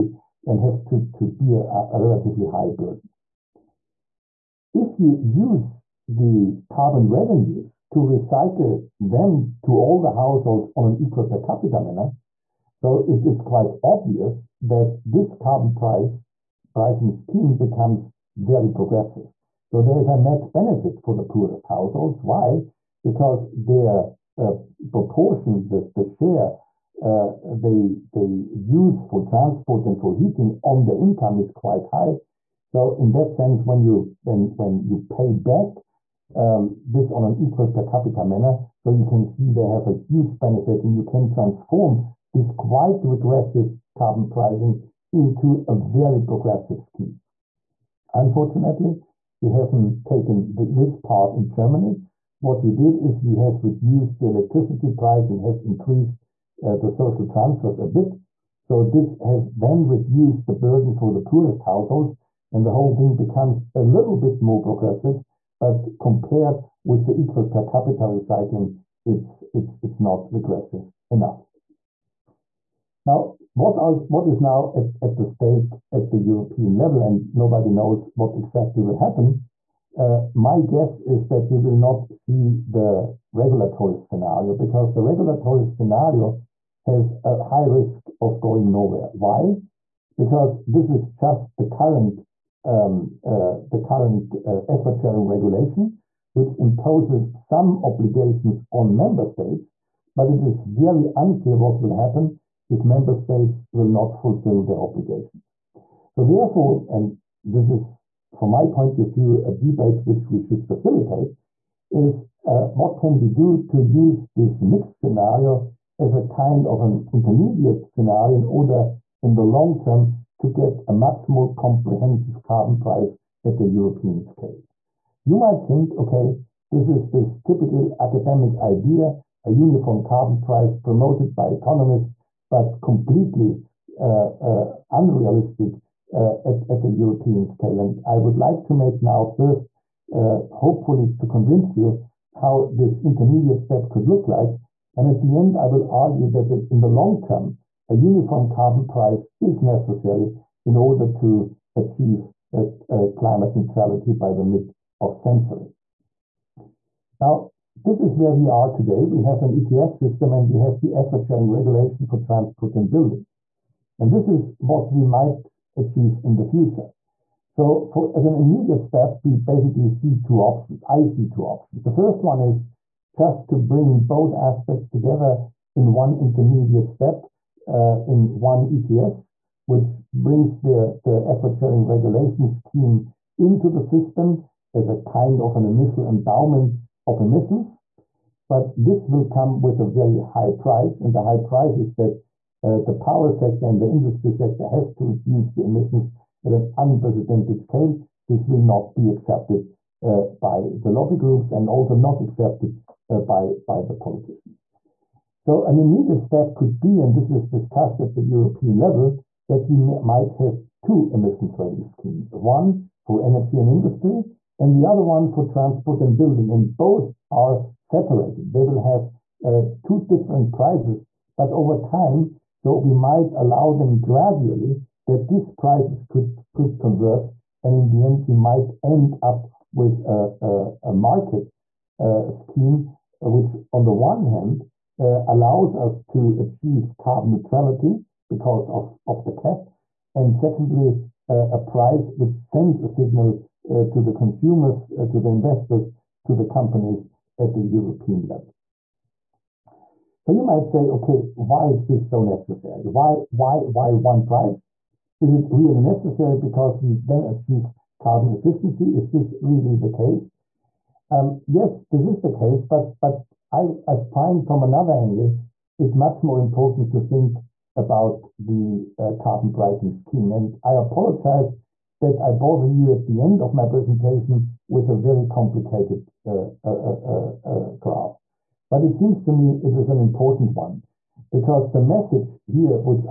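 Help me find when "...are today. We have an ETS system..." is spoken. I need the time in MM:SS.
02:38.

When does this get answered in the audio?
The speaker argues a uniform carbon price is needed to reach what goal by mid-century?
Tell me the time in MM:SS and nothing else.
02:33.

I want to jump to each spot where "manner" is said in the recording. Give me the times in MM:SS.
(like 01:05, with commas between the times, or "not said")
00:11, 00:38.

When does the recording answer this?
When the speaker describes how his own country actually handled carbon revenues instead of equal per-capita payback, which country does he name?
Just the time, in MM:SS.
00:51.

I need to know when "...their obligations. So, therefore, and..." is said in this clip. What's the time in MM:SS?
01:44.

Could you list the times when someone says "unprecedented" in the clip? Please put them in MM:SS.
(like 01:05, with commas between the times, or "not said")
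03:16.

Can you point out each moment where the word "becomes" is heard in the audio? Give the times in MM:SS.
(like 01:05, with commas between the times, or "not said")
00:17, 01:03.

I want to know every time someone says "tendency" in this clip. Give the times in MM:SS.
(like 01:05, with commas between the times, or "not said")
not said.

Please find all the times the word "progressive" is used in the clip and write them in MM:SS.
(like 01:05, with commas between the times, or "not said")
00:18, 00:46, 01:04.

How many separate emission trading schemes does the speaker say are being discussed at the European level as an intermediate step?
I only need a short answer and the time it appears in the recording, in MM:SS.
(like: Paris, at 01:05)
2, at 03:30.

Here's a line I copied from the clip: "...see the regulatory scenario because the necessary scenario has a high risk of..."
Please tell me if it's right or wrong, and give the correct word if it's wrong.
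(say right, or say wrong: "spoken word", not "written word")
wrong: "regulatory", not "necessary".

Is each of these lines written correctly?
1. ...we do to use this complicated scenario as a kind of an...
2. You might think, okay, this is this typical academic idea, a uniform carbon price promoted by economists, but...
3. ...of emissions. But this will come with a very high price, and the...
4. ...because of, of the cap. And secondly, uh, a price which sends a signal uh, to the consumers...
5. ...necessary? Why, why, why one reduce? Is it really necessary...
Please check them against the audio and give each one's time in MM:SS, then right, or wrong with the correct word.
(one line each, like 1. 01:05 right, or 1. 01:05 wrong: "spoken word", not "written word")
1. 01:53 wrong: "mixed", not "complicated"
2. 02:05 right
3. 03:07 right
4. 03:58 right
5. 04:12 wrong: "price", not "reduce".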